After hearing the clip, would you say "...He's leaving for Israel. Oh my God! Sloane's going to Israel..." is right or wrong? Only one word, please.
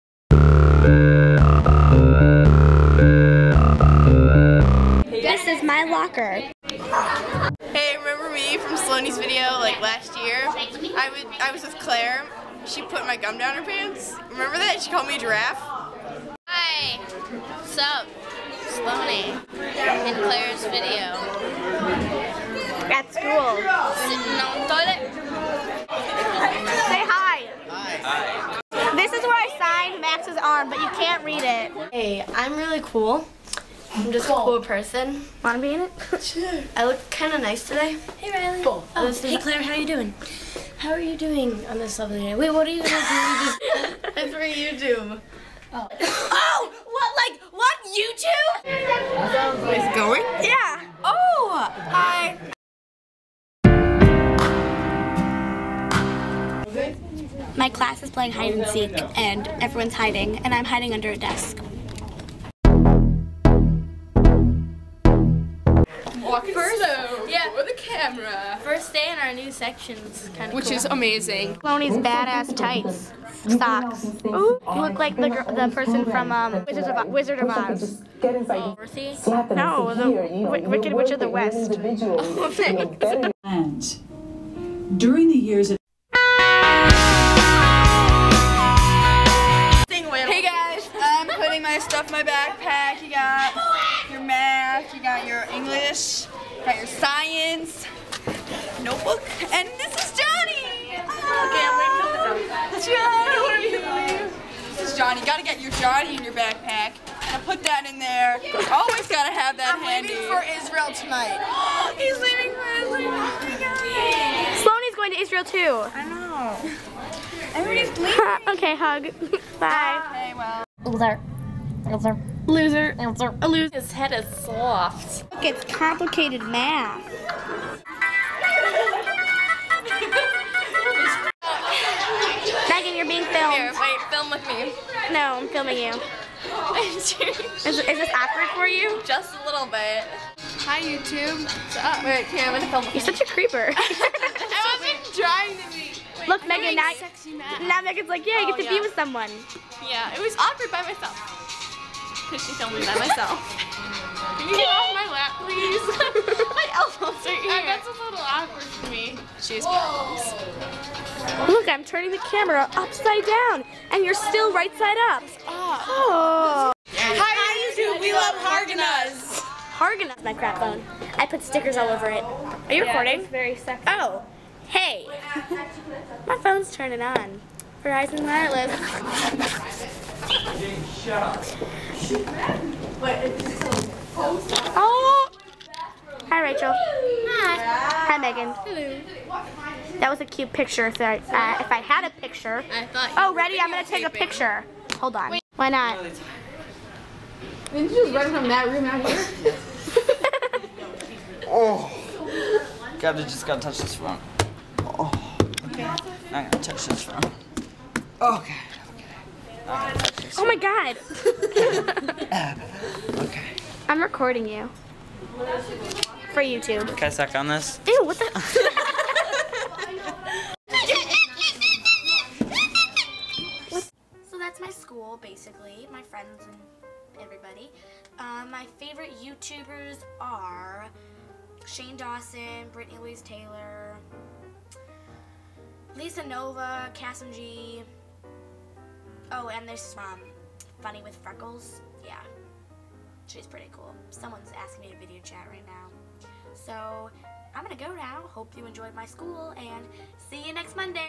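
right.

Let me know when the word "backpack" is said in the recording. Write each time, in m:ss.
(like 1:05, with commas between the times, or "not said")
1:32, 1:46.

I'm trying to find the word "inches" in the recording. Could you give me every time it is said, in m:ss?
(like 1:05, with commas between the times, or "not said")
not said.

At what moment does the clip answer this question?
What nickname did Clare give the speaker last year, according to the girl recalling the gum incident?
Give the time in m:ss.
0:15.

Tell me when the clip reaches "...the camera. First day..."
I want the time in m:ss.
1:07.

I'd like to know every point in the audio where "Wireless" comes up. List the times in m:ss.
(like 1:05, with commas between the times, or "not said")
2:58.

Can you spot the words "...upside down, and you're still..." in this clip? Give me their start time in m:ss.
2:42.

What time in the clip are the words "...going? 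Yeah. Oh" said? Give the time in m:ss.
0:49.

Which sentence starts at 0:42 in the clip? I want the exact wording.
Wait, what are you going to do?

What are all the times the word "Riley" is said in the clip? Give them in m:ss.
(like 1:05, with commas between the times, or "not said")
0:38.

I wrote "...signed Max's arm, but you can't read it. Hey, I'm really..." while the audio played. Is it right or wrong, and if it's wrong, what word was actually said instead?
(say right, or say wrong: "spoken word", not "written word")
right.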